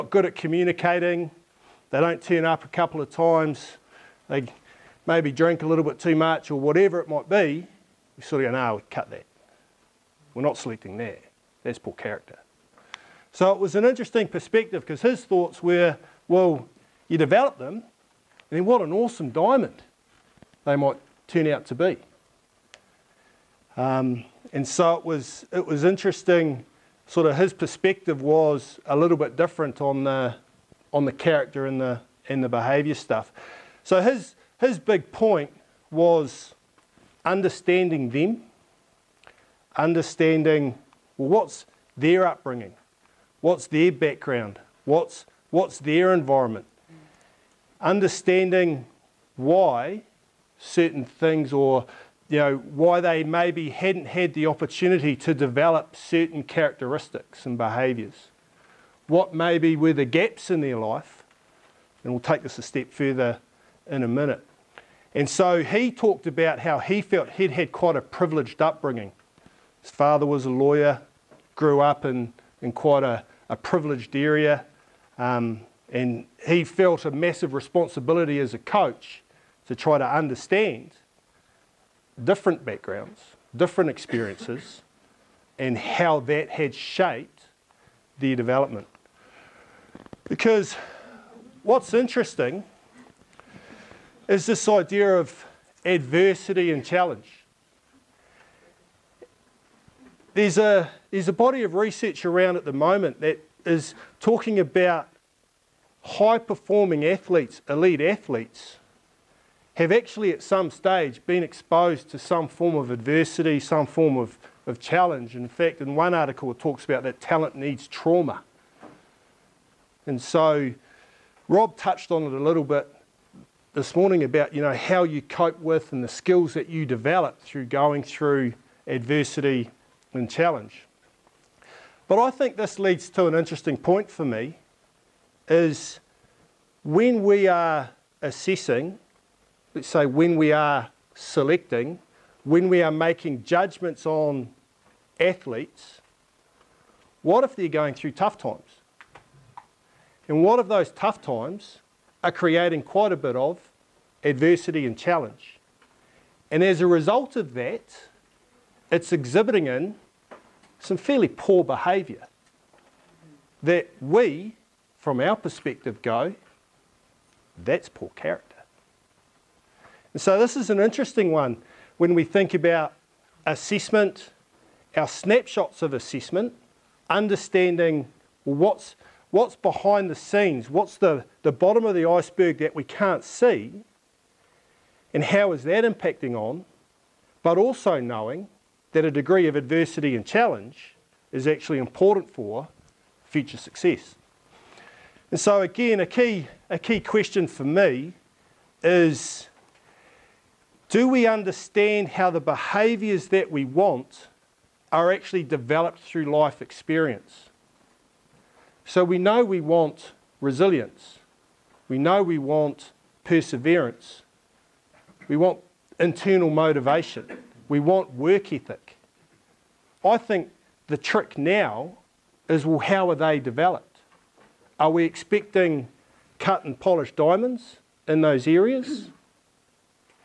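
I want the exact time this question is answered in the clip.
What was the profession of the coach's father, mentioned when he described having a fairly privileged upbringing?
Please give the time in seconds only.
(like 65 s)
70 s.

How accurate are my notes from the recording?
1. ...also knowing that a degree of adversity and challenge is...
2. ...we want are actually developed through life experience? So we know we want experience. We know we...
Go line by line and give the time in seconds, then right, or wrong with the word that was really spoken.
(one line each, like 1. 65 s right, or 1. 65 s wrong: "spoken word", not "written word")
1. 187 s right
2. 203 s wrong: "resilience", not "experience".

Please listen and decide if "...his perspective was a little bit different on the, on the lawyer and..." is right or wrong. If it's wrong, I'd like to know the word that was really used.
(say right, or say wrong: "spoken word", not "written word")
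wrong: "character", not "lawyer".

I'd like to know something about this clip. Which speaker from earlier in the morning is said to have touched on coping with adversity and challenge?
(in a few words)
Rob.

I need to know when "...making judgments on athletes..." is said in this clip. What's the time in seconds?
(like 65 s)
142 s.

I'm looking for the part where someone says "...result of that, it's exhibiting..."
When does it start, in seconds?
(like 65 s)
156 s.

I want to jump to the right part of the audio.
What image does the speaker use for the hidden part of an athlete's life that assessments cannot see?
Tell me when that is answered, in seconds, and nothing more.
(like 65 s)
181 s.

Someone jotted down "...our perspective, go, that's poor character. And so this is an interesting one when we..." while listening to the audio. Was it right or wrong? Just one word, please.
right.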